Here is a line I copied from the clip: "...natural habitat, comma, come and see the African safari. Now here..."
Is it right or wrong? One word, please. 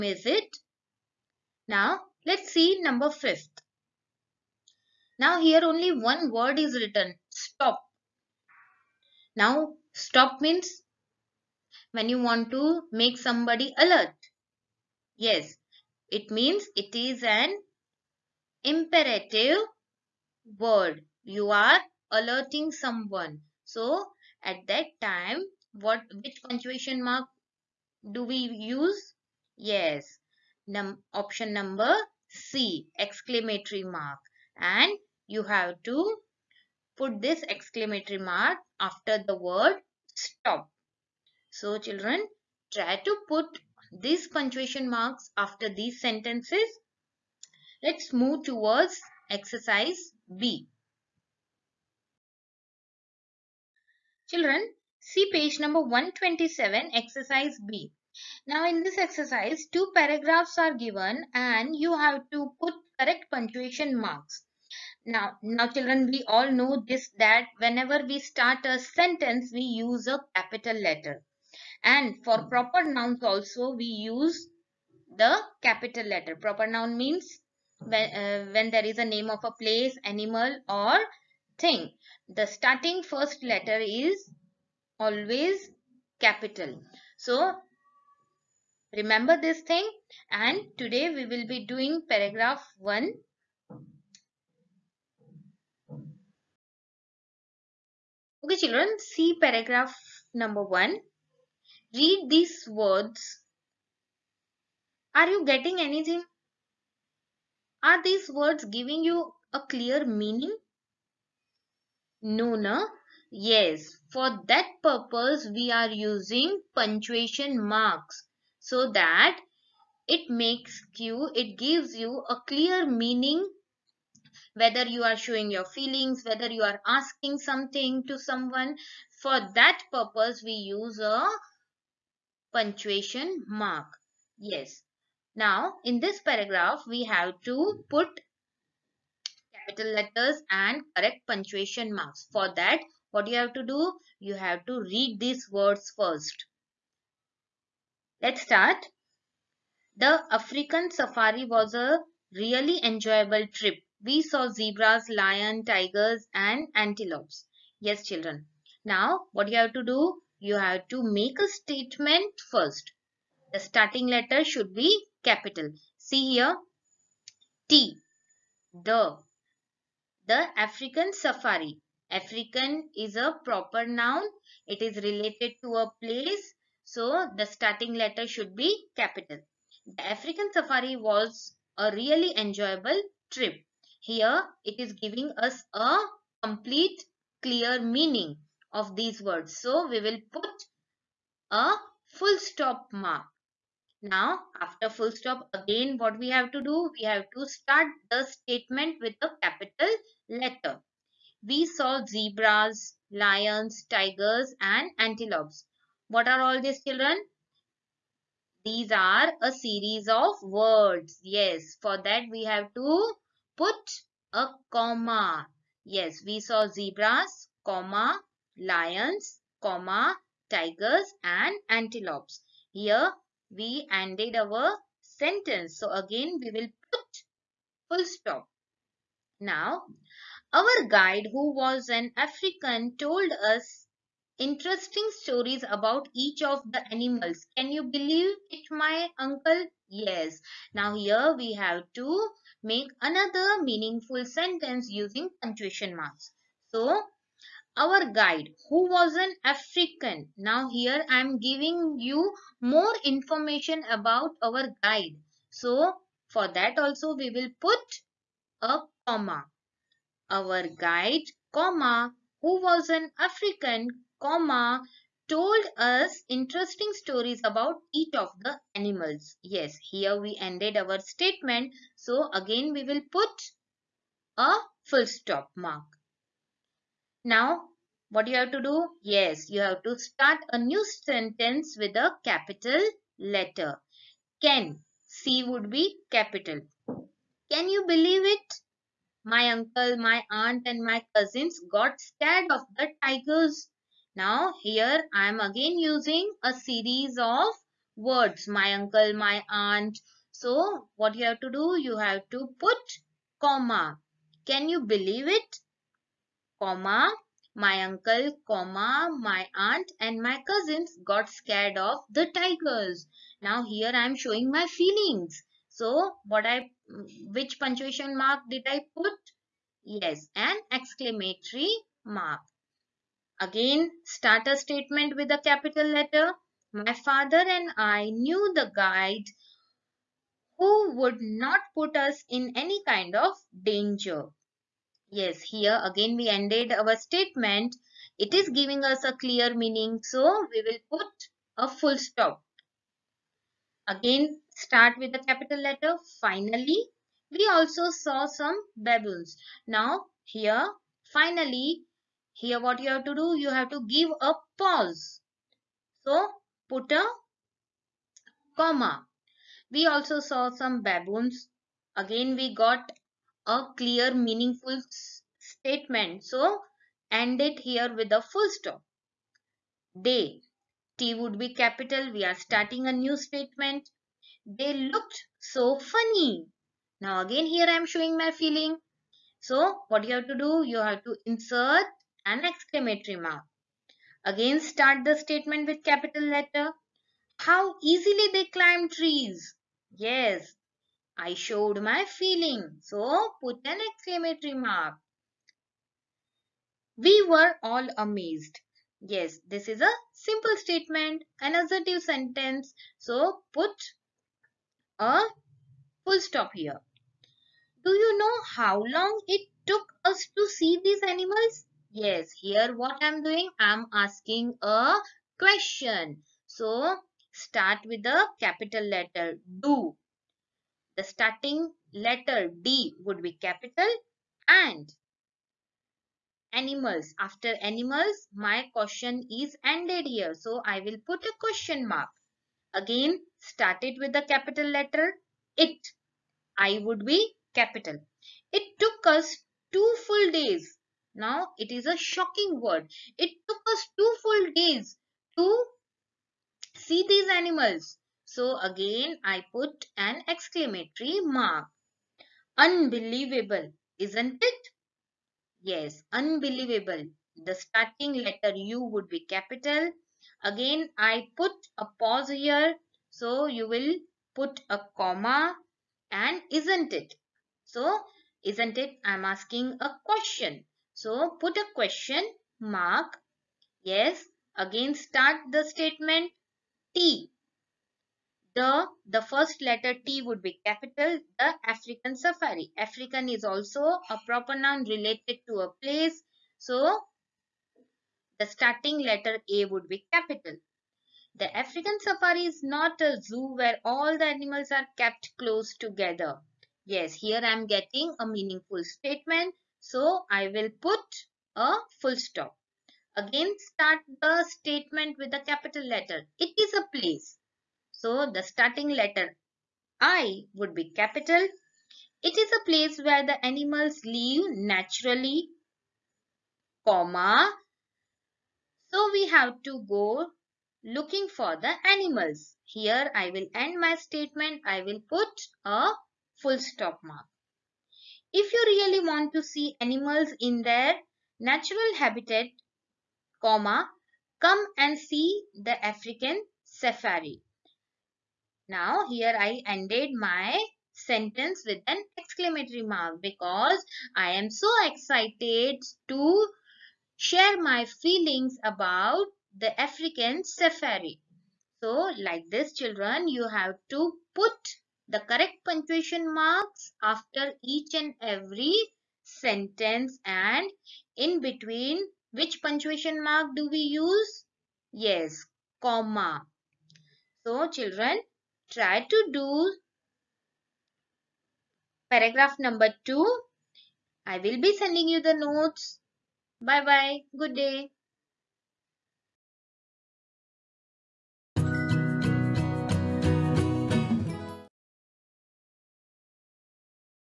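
right.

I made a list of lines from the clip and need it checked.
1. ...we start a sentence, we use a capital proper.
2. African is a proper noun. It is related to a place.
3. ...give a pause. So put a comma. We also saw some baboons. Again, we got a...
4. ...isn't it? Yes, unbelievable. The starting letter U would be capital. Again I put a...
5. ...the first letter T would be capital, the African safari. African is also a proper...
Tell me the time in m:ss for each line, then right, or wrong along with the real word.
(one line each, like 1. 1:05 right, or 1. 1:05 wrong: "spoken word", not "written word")
1. 1:08 wrong: "letter", not "proper"
2. 2:52 right
3. 5:53 right
4. 7:33 right
5. 7:59 right.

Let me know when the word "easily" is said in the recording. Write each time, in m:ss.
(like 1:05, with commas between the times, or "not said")
6:27.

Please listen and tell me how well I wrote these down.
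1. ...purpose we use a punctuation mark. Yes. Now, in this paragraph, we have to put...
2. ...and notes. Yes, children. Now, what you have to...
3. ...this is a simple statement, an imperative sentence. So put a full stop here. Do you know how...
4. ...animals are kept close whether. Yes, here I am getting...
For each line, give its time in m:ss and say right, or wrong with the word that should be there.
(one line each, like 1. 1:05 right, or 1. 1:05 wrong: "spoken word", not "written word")
1. 2:09 right
2. 2:36 wrong: "antelopes", not "notes"
3. 6:39 wrong: "assertive", not "imperative"
4. 8:14 wrong: "together", not "whether".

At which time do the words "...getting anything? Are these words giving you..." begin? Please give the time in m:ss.
1:45.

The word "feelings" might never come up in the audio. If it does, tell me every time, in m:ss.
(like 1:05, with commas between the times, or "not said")
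2:05, 5:14, 6:18, 6:32, 9:07.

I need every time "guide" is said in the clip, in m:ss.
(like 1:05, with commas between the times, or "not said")
3:50, 4:08, 4:14, 4:20, 5:28.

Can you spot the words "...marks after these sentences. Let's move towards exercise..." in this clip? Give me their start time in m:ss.
0:44.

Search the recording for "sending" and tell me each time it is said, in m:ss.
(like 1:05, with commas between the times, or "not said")
9:34.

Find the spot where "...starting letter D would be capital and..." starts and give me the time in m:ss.
7:01.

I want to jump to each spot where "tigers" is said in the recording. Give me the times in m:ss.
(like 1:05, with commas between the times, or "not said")
2:35, 3:23, 3:40, 4:53, 5:12.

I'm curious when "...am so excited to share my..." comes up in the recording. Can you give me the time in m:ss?
9:04.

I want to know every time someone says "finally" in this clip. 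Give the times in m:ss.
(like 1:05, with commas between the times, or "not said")
5:46, 5:51.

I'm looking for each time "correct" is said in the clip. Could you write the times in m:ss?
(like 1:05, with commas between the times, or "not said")
1:02, 2:20, 9:15.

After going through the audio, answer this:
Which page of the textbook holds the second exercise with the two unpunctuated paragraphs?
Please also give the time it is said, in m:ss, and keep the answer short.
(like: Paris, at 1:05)
127, at 0:55.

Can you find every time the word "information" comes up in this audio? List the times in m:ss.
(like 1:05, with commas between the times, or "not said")
4:13.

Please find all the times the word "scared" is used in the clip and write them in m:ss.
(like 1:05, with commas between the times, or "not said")
4:51, 5:11.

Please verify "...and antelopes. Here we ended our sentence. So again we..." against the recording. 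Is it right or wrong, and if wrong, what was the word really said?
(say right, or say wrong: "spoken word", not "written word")
right.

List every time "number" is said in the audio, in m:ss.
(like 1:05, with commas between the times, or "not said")
0:02, 0:31, 0:55, 1:40, 9:32.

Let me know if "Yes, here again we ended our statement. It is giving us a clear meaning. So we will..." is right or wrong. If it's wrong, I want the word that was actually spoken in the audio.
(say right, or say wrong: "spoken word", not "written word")
right.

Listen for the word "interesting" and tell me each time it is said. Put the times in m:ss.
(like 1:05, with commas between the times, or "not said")
3:54, 4:26.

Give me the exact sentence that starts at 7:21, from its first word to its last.
Now it is a shocking word.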